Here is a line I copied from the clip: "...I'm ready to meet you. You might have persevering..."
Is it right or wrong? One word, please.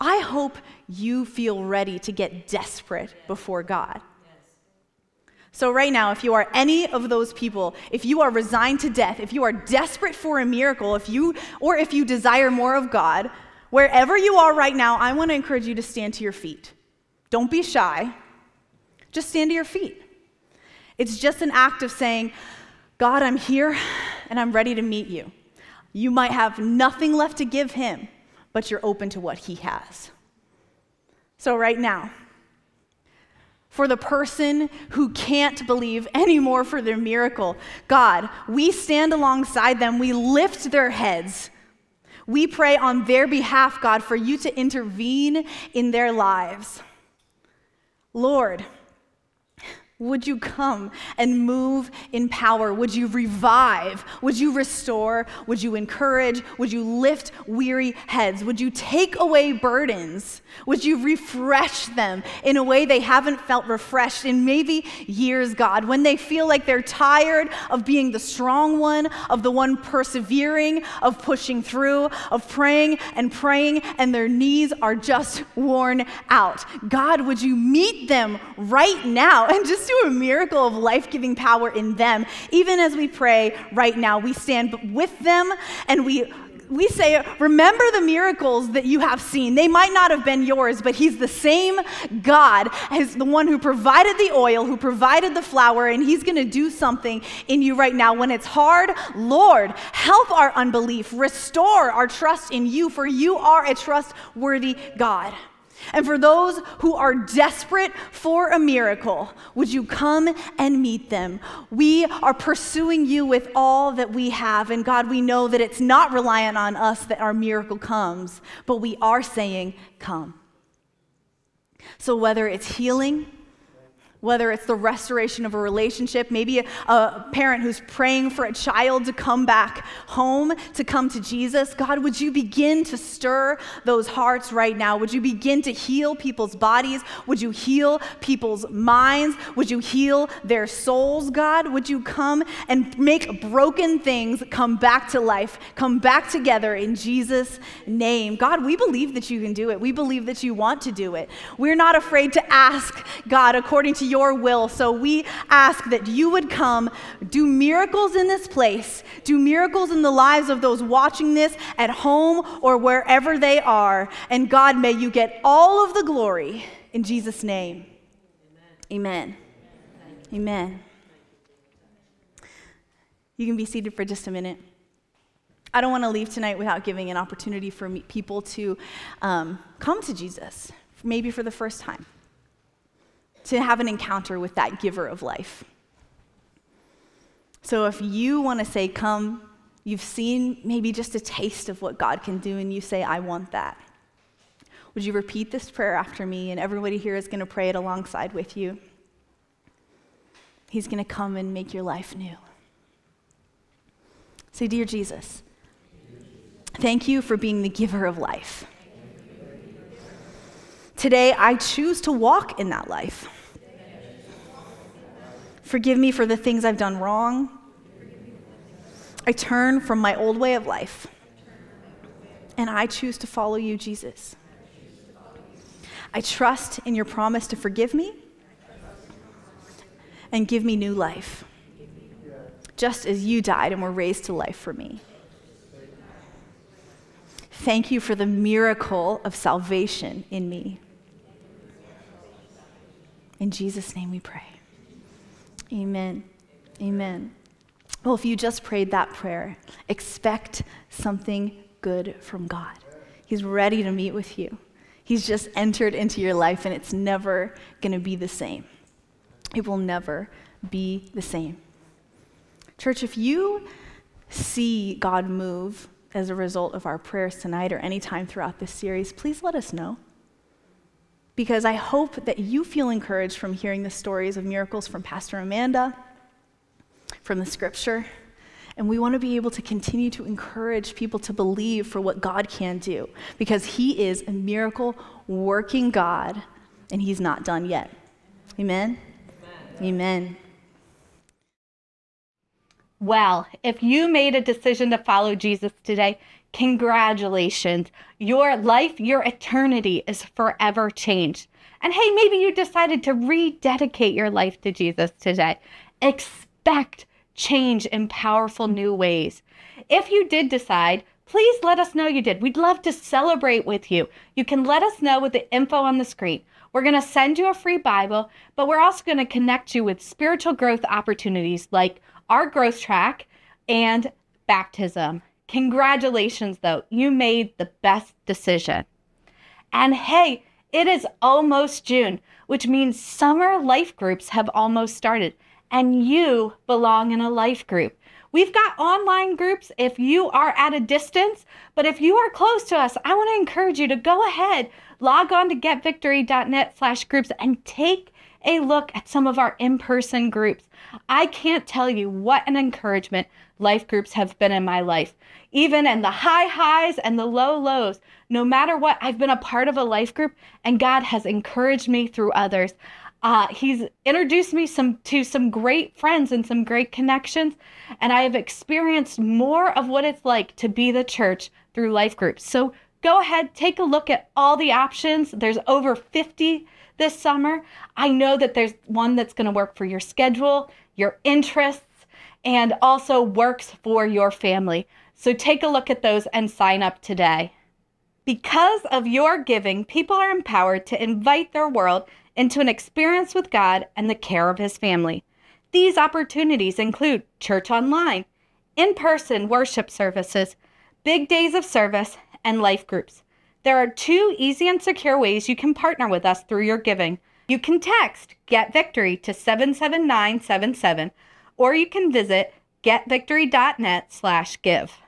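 wrong.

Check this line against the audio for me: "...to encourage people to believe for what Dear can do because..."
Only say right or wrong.
wrong.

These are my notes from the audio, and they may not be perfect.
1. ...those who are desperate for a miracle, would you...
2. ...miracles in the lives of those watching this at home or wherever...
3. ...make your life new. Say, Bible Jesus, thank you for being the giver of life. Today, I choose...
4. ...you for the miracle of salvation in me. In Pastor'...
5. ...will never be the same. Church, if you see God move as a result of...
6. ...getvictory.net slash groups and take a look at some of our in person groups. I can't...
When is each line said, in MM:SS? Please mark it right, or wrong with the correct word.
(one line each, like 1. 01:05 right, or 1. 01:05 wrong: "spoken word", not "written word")
1. 01:46 right
2. 02:39 right
3. 03:21 wrong: "Dear", not "Bible"
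4. 03:57 wrong: "Jesus", not "Pastor"
5. 04:19 right
6. 05:45 right.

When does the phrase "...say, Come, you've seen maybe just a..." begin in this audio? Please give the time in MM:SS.
03:08.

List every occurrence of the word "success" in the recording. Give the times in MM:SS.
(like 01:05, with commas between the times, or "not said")
not said.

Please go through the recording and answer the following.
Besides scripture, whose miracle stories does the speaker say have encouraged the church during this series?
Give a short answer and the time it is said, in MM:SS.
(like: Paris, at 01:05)
Pastor Amanda, at 04:35.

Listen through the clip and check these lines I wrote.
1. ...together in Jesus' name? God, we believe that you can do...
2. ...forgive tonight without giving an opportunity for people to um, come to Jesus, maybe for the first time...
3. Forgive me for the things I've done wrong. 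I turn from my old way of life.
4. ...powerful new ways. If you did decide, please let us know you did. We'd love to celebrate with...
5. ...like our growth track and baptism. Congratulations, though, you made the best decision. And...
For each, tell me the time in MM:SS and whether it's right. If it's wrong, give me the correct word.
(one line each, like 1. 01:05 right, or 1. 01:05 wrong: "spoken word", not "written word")
1. 02:26 right
2. 02:56 wrong: "leave", not "forgive"
3. 03:35 right
4. 05:08 right
5. 05:21 right.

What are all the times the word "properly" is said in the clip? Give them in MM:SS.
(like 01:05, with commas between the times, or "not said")
not said.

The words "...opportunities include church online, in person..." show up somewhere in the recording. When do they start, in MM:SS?
06:35.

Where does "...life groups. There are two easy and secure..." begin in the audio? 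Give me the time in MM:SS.
06:42.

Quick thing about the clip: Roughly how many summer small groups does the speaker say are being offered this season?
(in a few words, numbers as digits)
over 50.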